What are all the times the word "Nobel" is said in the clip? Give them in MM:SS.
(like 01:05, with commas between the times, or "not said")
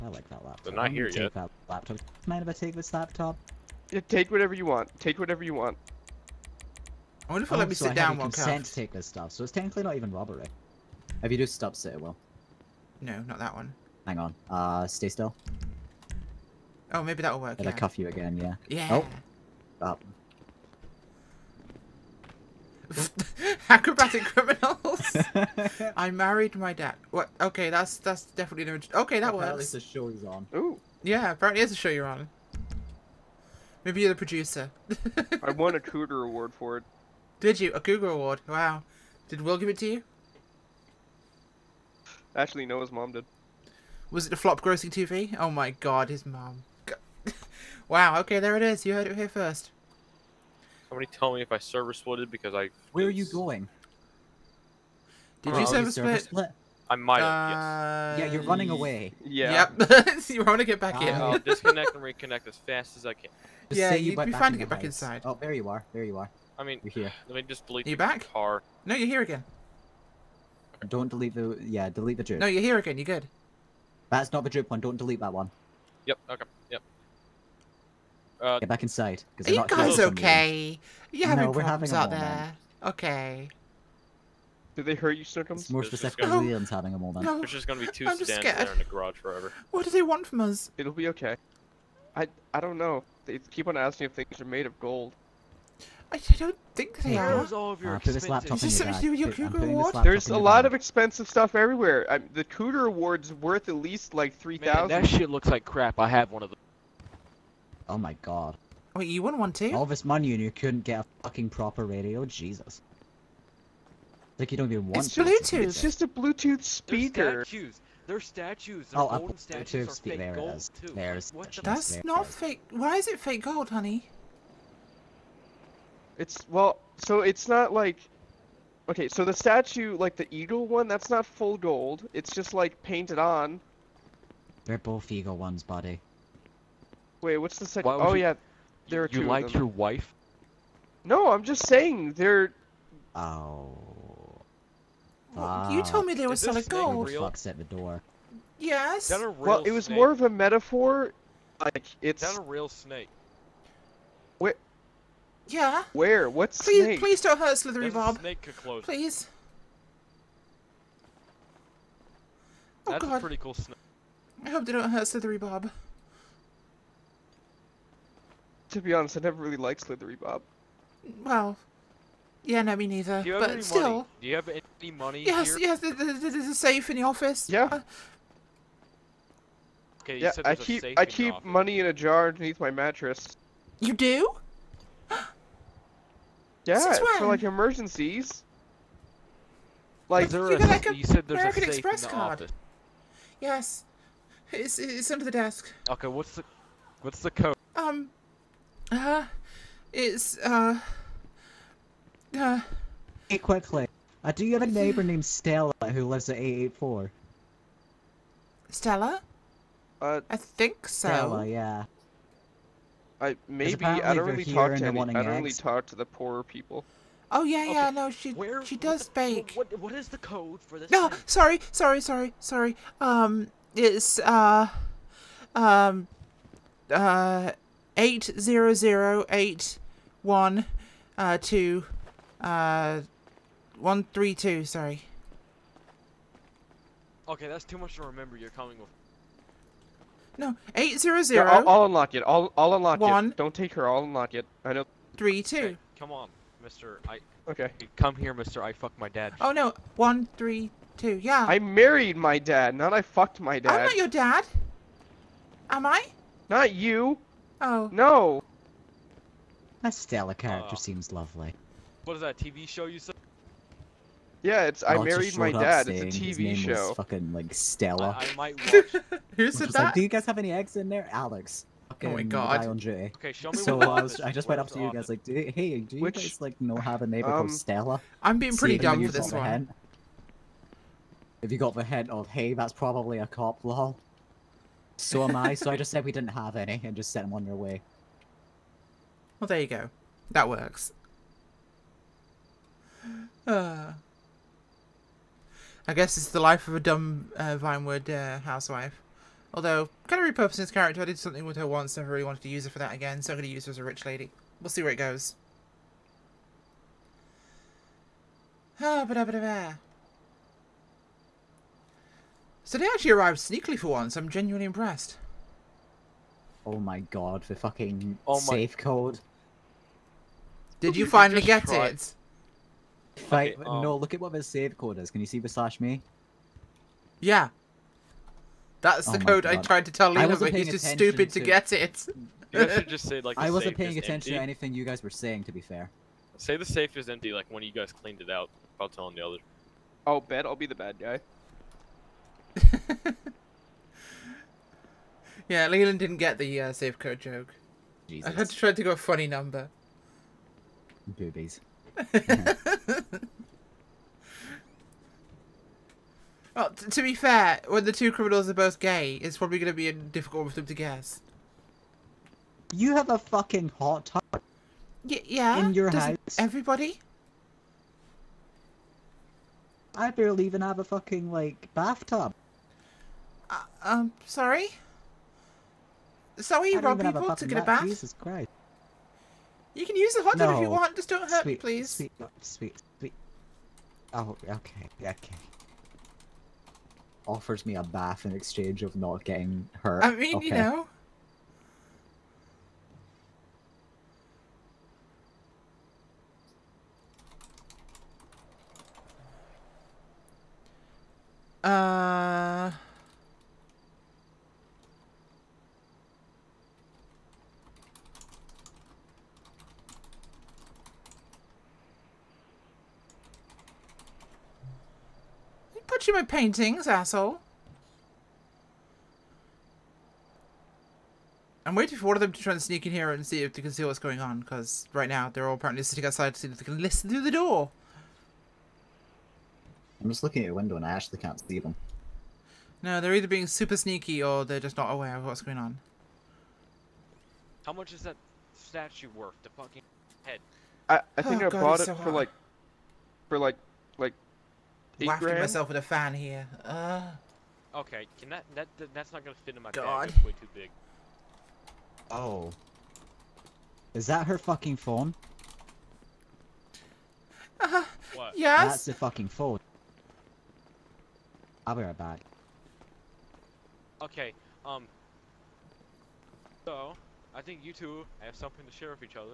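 not said.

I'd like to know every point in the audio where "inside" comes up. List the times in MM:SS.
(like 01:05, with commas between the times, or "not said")
01:04, 01:18.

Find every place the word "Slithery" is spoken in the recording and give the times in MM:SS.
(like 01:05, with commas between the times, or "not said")
02:37, 02:45, 02:49.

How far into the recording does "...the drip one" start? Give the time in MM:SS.
01:14.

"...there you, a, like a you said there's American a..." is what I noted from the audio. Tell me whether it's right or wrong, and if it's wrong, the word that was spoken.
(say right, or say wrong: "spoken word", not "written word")
right.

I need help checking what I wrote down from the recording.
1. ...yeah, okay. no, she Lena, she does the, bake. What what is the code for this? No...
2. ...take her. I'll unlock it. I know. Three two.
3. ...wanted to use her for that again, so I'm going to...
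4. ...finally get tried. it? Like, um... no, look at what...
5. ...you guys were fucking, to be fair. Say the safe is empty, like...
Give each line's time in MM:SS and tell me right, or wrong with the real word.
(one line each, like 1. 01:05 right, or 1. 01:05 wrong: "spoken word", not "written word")
1. 03:37 wrong: "Where", not "Lena"
2. 04:03 right
3. 05:02 right
4. 05:21 right
5. 05:34 wrong: "saying", not "fucking".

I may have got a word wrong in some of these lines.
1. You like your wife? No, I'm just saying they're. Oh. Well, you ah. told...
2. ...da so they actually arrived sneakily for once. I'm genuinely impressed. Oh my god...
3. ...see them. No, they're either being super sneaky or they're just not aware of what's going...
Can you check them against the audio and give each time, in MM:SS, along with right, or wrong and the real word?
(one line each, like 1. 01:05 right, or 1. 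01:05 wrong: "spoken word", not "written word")
1. 02:19 right
2. 05:09 right
3. 07:11 right.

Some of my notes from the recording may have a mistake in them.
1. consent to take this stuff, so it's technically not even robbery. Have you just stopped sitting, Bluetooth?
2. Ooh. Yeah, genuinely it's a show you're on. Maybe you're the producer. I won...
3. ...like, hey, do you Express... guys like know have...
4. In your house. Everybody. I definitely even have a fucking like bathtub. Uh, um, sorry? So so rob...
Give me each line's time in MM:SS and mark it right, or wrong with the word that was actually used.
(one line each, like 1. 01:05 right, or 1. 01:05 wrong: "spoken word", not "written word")
1. 00:08 wrong: "Will", not "Bluetooth"
2. 00:30 wrong: "apparently", not "genuinely"
3. 04:35 wrong: "Which", not "Express"
4. 06:05 wrong: "barely", not "definitely".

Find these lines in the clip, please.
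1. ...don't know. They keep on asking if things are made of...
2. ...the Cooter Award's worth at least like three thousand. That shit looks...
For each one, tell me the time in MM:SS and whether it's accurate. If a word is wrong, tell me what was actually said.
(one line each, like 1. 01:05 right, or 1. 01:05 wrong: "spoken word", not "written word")
1. 01:32 right
2. 01:42 right.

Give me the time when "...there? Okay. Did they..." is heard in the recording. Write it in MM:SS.
01:22.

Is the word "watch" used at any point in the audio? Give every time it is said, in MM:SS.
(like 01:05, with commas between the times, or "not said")
04:28.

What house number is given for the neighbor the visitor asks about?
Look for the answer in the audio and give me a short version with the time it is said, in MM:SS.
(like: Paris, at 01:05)
884, at 03:26.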